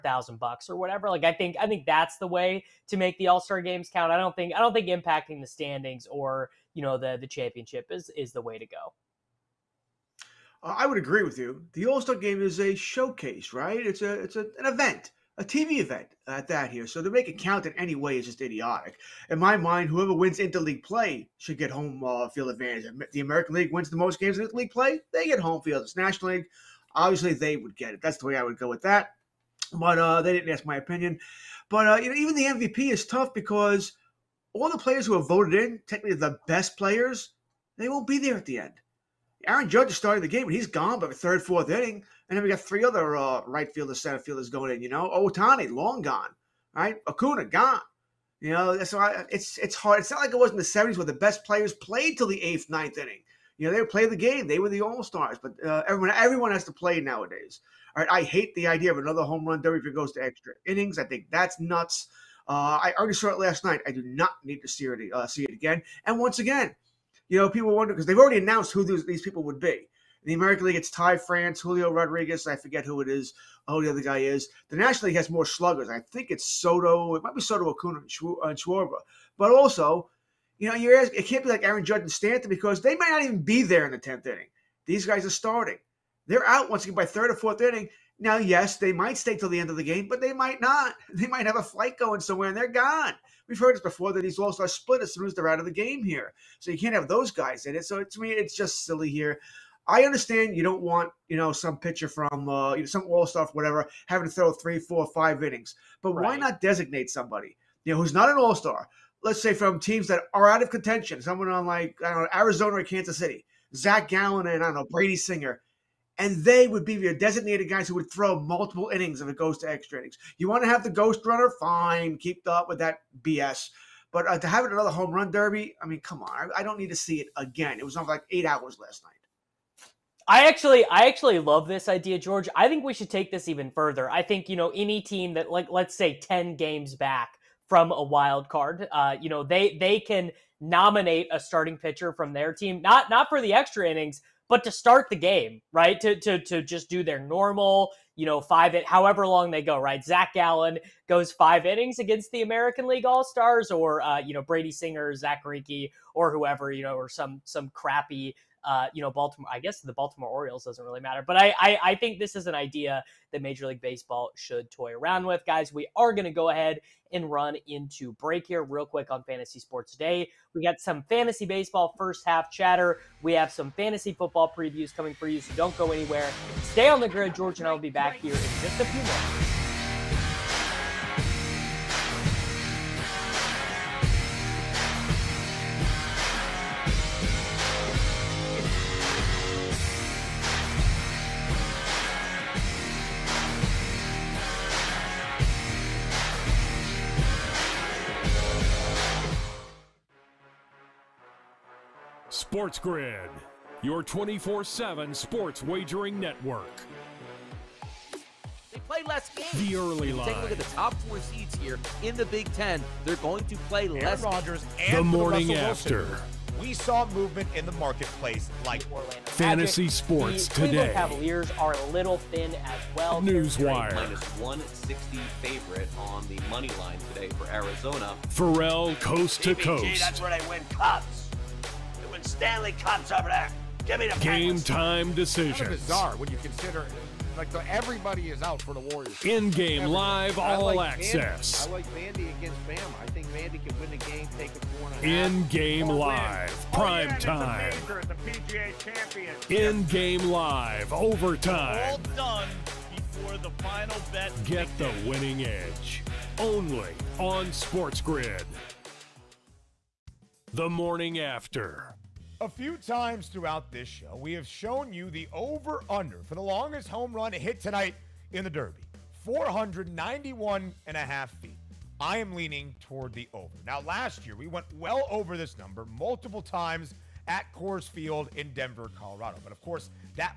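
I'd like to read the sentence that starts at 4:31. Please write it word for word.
I am leaning toward the over.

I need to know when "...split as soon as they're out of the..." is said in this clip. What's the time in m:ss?
1:34.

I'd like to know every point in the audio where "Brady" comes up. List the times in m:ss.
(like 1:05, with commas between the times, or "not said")
1:54, 2:34.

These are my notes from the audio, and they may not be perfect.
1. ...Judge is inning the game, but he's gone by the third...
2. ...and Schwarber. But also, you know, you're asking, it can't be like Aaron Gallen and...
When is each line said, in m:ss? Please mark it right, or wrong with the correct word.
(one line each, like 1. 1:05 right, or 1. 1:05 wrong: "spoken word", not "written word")
1. 0:39 wrong: "starting", not "inning"
2. 1:17 wrong: "Judge", not "Gallen".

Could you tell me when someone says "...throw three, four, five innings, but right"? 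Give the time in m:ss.
1:44.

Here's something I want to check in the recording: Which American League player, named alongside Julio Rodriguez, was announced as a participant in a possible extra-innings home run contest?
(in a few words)
Ty France.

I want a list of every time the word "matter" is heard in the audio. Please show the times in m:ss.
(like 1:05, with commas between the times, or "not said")
2:40.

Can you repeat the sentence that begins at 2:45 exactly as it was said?
We are going to go ahead and run into break here real quick on Fantasy Sports Today.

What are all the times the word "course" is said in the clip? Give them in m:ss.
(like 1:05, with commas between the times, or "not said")
4:39.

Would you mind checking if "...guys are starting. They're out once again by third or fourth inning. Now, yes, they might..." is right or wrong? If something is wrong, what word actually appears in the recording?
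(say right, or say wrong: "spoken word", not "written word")
right.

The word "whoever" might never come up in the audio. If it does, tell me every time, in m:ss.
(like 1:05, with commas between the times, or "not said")
0:19, 2:36.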